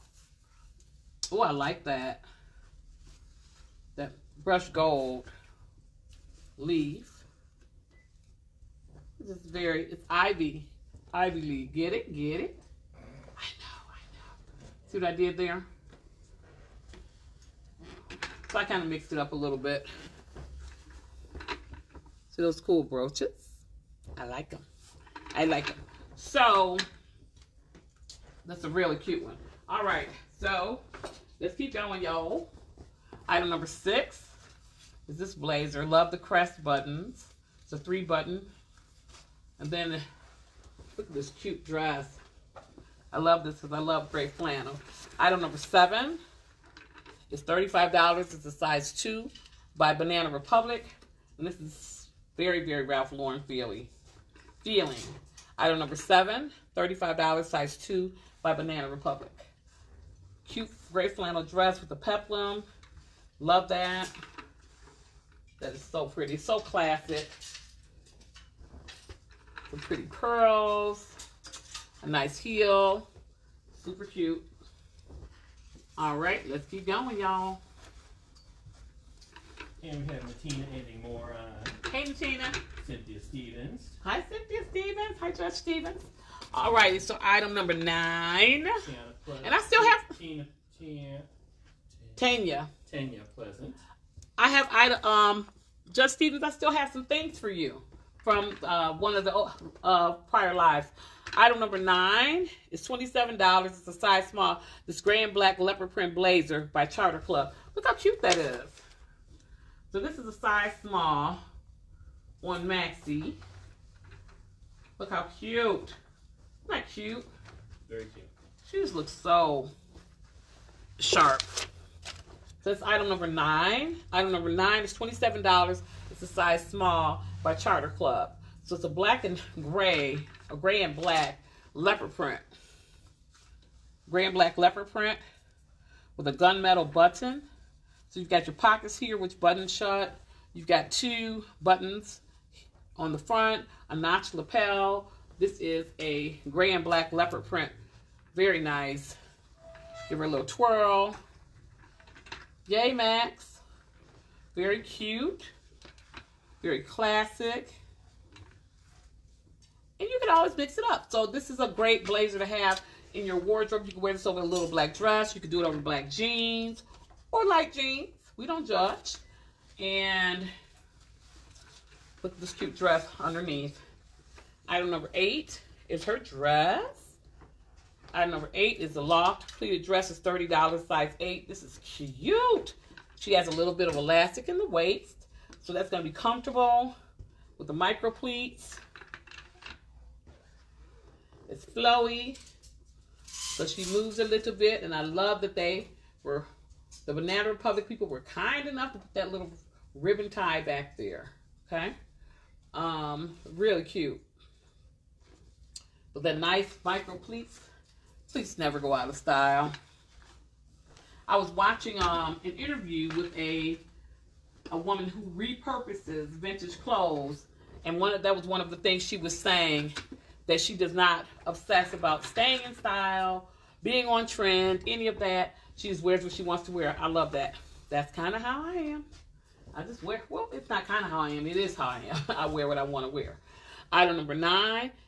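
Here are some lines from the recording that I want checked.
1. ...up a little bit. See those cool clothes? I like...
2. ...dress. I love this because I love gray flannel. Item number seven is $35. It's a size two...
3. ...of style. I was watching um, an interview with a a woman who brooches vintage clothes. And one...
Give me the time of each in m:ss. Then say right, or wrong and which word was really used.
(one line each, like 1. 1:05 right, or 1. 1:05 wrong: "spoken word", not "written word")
1. 0:19 wrong: "brooches", not "clothes"
2. 0:41 right
3. 3:29 wrong: "repurposes", not "brooches".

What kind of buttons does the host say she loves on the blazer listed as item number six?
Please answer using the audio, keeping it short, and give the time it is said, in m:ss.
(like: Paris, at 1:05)
Crest buttons, at 0:36.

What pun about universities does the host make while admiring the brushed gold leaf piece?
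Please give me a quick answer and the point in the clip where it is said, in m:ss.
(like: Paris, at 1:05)
Ivy League, at 0:11.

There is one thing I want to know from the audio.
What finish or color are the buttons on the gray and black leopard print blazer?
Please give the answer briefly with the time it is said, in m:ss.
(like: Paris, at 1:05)
Gunmetal, at 2:16.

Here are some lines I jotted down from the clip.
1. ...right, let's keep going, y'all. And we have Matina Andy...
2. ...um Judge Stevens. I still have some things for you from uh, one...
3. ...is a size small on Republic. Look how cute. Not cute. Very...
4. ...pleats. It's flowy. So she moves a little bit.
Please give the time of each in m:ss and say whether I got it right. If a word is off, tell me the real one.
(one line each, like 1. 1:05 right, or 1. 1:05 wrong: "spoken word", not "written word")
1. 1:16 right
2. 1:35 right
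3. 1:50 wrong: "Maxi", not "Republic"
4. 3:08 right.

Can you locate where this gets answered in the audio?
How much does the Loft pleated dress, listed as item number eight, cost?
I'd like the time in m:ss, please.
3:00.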